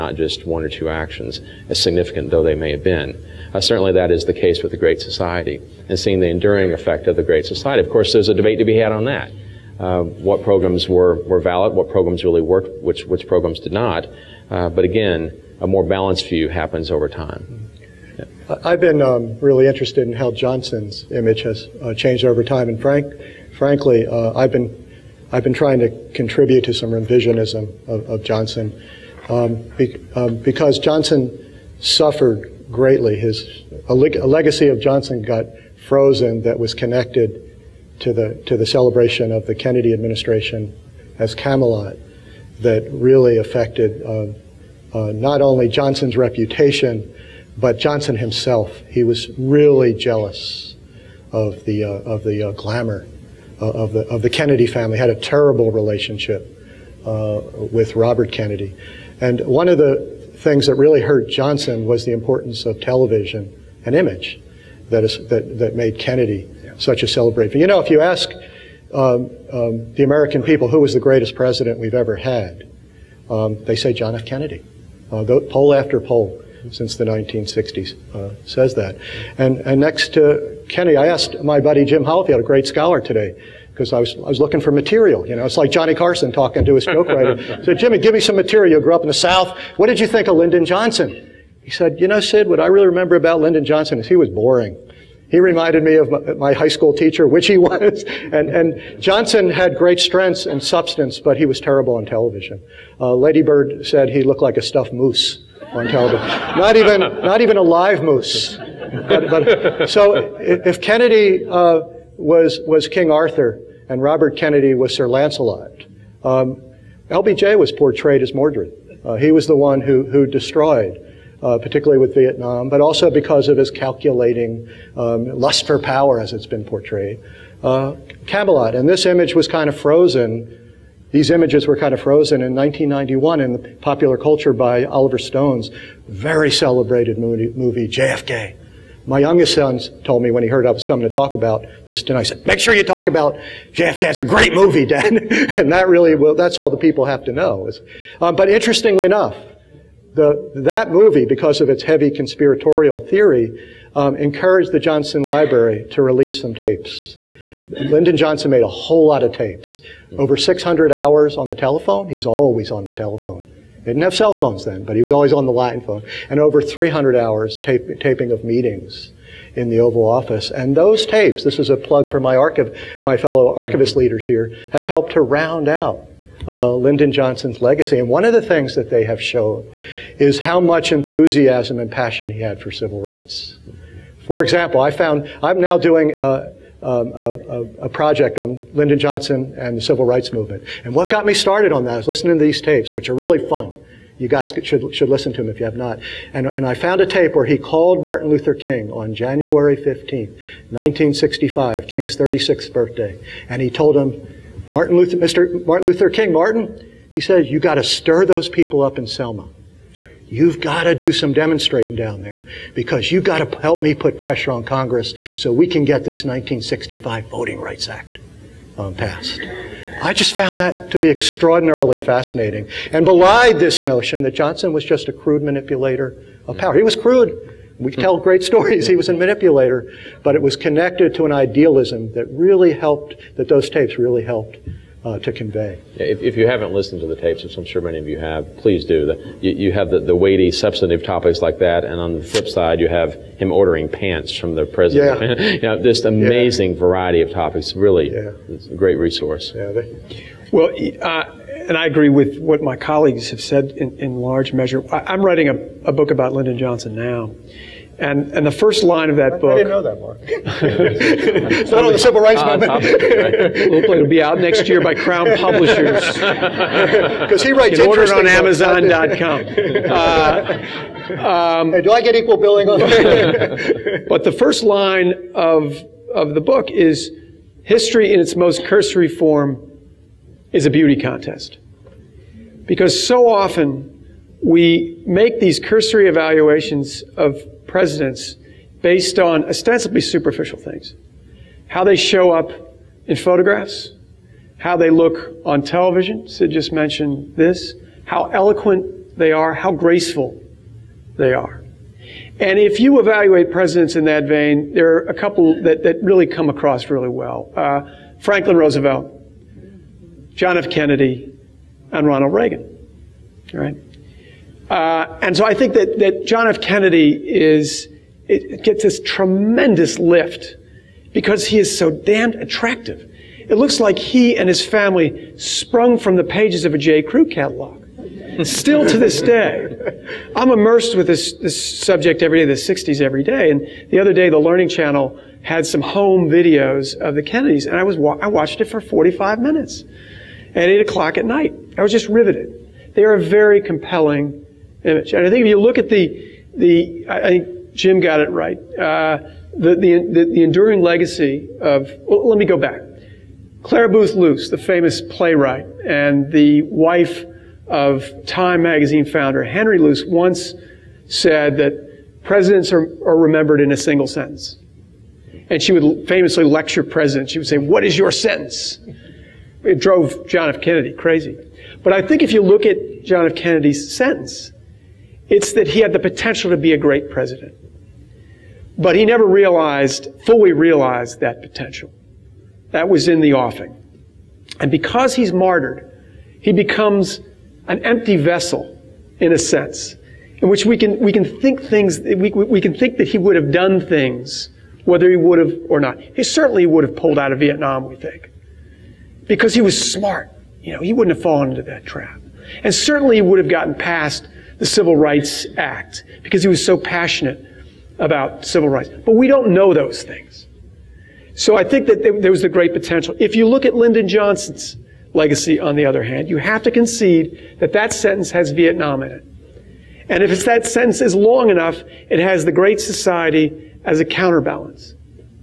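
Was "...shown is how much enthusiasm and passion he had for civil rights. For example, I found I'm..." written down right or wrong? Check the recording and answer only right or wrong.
right.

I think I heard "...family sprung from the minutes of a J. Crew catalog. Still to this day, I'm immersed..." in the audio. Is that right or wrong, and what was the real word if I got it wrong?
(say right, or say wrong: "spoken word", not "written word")
wrong: "pages", not "minutes".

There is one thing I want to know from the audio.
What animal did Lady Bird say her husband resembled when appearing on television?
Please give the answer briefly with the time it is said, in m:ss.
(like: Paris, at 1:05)
a stuffed moose, at 1:44.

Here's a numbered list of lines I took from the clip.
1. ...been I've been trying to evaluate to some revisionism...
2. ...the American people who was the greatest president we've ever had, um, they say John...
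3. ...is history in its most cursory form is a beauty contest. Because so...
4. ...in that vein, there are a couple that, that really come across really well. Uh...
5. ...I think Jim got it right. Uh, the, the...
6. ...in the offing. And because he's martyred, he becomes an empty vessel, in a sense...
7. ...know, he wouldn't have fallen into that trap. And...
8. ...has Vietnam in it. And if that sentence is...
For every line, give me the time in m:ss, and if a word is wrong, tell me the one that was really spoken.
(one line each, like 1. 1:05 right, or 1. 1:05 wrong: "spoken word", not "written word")
1. 0:24 wrong: "contribute", not "evaluate"
2. 1:09 right
3. 4:36 right
4. 5:03 right
5. 5:47 right
6. 6:23 right
7. 6:40 right
8. 6:58 right.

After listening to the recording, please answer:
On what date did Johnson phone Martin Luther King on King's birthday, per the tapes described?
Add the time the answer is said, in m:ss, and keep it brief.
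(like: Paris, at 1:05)
January 15th, 1965, at 3:19.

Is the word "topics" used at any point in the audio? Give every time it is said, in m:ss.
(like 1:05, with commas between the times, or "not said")
4:01, 4:07.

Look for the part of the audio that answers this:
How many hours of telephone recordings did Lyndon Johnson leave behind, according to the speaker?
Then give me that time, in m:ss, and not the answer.
2:40.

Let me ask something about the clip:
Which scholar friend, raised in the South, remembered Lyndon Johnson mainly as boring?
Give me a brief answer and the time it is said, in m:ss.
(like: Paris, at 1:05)
Jim Hollifield, at 1:21.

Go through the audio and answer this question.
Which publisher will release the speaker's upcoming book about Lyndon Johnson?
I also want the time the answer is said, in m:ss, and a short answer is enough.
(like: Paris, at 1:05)
Crown Publishers, at 4:24.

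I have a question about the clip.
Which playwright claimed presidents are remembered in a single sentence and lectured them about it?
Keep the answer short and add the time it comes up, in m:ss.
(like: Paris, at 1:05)
Clare Boothe Luce, at 5:53.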